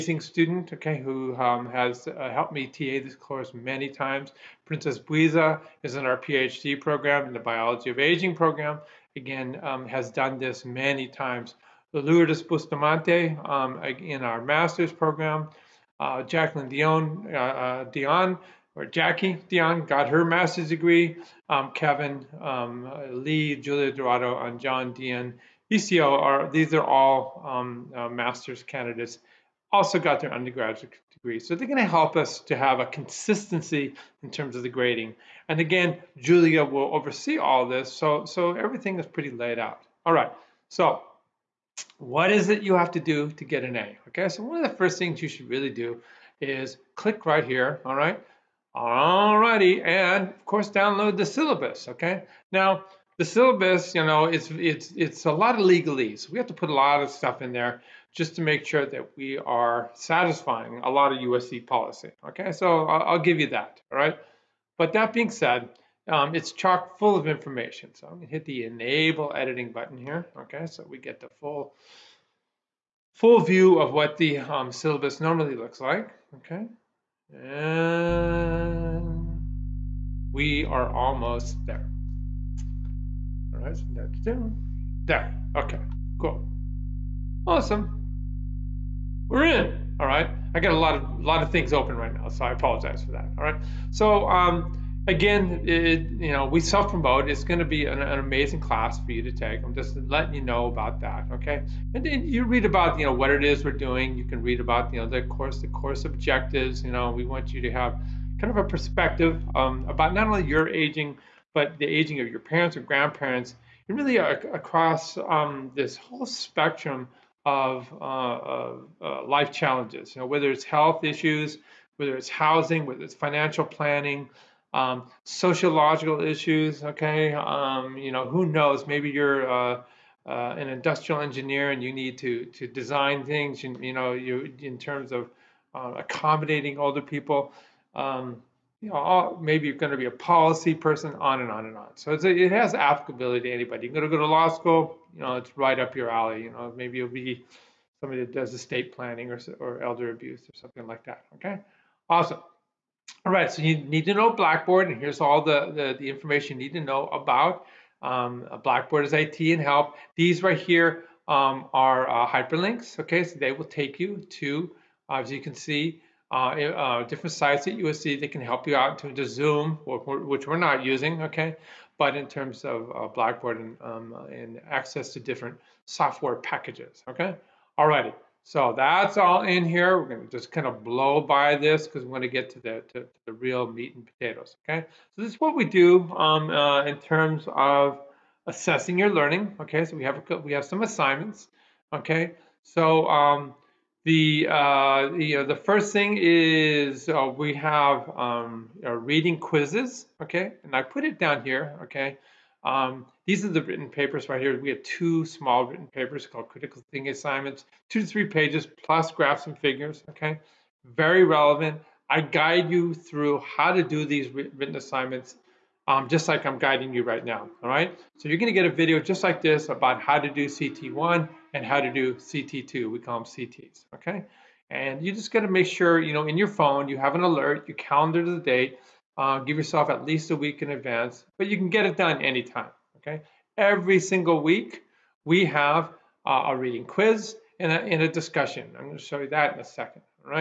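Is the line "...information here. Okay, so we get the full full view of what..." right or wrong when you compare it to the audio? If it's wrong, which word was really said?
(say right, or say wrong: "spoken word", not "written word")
wrong: "button", not "information".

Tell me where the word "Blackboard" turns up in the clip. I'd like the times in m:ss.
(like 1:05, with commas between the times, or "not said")
2:34, 2:38, 2:53.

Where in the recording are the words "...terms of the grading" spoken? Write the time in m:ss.
0:34.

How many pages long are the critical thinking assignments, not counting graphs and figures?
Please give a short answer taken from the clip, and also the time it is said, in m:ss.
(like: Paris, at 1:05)
2 to 3, at 3:27.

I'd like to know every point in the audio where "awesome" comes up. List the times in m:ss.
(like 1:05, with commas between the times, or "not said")
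1:27, 2:32.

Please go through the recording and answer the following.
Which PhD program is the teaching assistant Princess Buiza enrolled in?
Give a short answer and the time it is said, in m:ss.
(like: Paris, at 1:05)
Biology of Aging, at 0:07.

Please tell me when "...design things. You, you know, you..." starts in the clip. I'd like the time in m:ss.
2:12.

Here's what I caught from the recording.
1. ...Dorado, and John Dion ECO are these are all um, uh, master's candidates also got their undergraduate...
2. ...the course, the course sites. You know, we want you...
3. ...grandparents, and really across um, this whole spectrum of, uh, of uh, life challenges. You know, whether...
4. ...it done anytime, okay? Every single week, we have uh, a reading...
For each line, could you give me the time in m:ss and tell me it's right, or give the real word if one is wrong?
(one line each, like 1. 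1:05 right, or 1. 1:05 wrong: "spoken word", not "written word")
1. 0:23 right
2. 1:45 wrong: "objectives", not "sites"
3. 1:52 right
4. 3:51 right.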